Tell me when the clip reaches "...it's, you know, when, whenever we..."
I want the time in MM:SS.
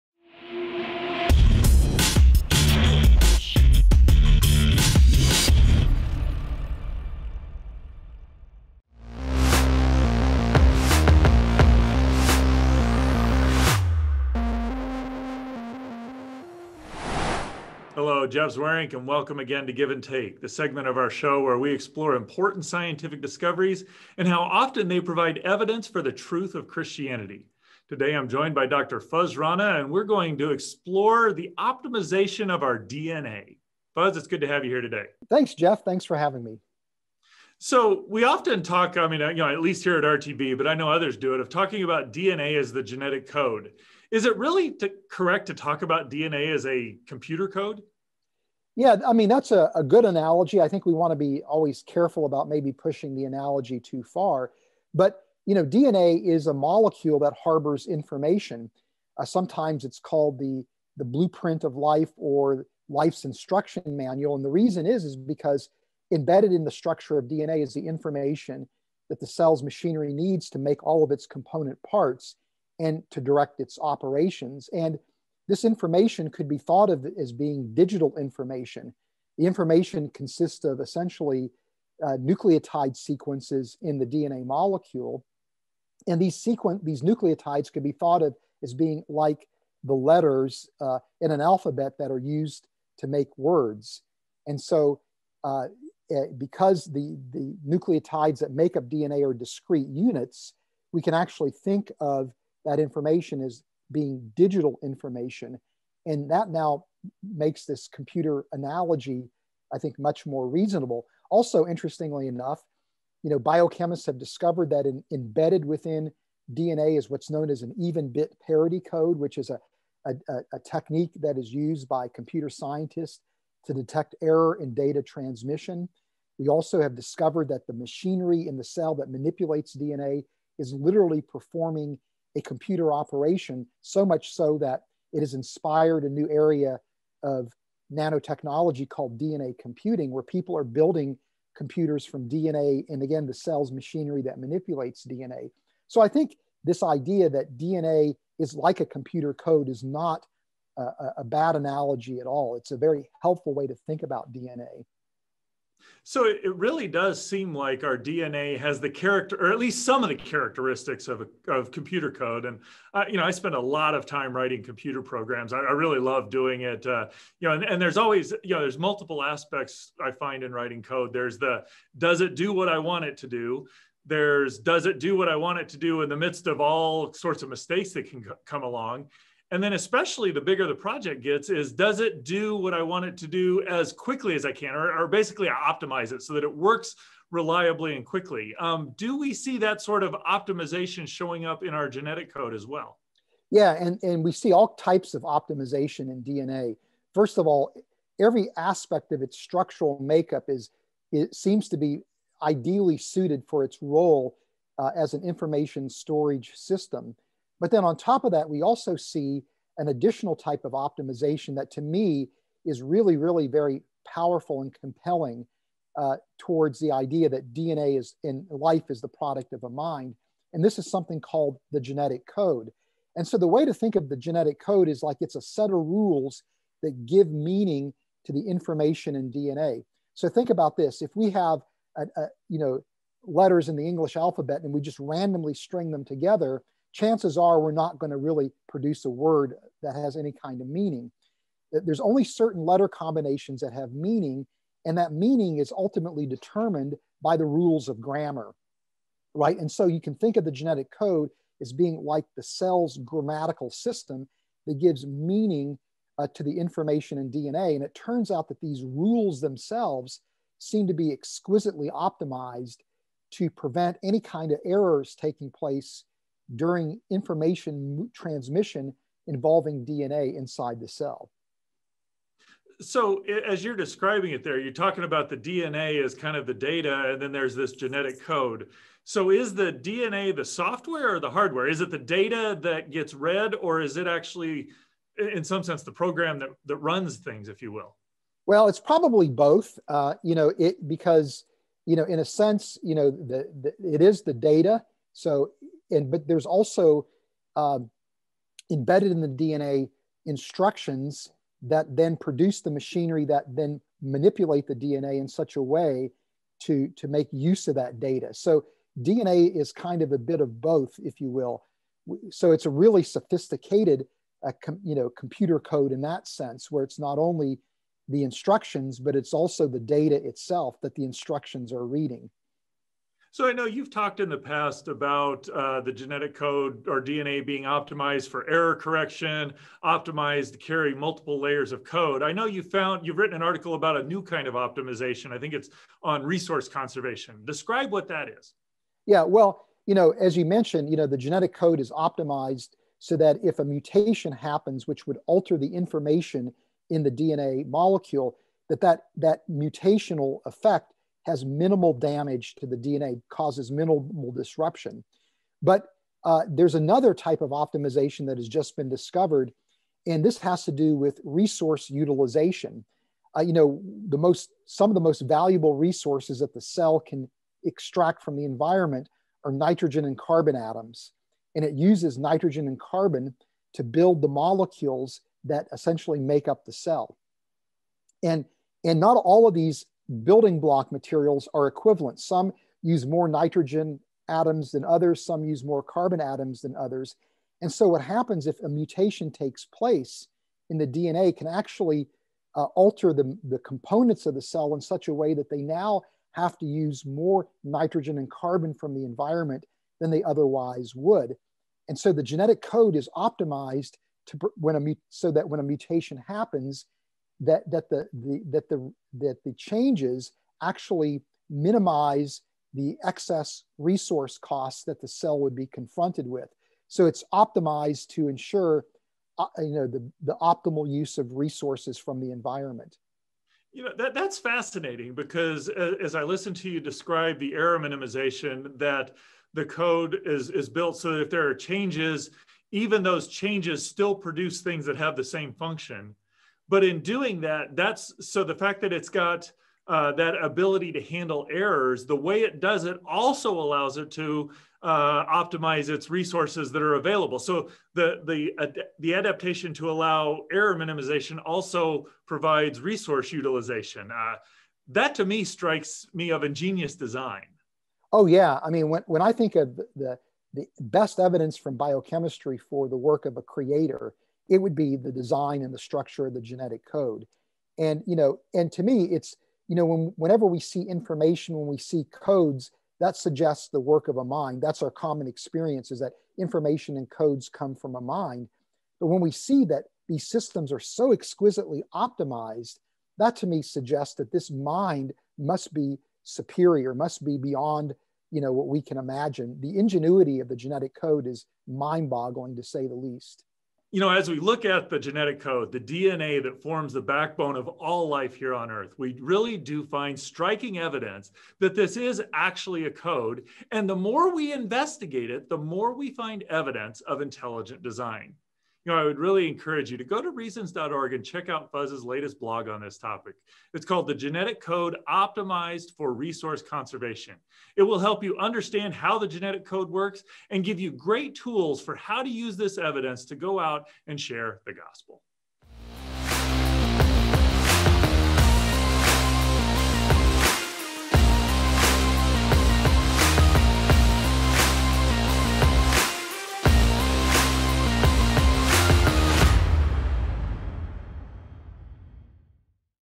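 07:49.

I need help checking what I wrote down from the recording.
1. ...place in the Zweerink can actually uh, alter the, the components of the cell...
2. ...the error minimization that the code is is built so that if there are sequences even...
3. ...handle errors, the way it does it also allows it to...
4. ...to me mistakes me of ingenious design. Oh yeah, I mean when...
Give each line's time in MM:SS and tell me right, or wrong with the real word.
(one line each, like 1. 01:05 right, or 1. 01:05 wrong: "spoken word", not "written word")
1. 06:29 wrong: "DNA", not "Zweerink"
2. 07:07 wrong: "changes", not "sequences"
3. 07:21 right
4. 07:35 wrong: "strikes", not "mistakes".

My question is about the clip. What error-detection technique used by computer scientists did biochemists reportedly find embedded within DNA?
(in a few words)
even bit parity code.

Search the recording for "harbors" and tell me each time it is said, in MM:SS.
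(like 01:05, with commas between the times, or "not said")
00:57.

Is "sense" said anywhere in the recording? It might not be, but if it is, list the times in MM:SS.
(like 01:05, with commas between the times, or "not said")
04:45, 04:52, 05:16.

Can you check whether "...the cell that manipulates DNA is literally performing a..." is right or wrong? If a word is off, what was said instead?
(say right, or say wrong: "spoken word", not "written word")
right.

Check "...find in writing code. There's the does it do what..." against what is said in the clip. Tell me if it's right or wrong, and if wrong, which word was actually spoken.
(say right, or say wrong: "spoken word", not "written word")
right.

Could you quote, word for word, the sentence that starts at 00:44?
Is it really to, correct to talk about DNA as a computer code?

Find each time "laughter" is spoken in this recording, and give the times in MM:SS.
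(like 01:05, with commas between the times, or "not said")
not said.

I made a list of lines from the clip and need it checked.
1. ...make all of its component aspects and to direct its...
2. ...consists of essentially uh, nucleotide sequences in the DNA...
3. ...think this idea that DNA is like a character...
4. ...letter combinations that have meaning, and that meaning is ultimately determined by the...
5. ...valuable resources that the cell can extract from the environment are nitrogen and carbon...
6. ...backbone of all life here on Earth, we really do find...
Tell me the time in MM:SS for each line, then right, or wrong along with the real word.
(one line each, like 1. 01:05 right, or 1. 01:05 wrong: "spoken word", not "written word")
1. 01:10 wrong: "parts", not "aspects"
2. 01:20 right
3. 02:26 wrong: "computer", not "character"
4. 04:02 right
5. 06:05 right
6. 08:17 right.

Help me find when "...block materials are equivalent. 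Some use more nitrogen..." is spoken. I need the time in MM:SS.
06:20.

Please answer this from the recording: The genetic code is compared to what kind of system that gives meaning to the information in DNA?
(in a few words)
grammatical system.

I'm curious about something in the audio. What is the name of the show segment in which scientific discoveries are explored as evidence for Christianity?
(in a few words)
Give and Take.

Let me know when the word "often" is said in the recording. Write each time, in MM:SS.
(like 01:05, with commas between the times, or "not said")
00:24, 00:38.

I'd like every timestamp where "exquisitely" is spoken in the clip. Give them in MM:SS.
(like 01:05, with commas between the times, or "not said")
04:21, 08:01.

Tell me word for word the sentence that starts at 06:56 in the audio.
So it's optimized to ensure uh, you know the, the optimal use of resources from the environment.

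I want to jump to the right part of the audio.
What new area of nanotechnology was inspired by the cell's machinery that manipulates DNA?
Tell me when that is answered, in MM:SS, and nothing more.
02:19.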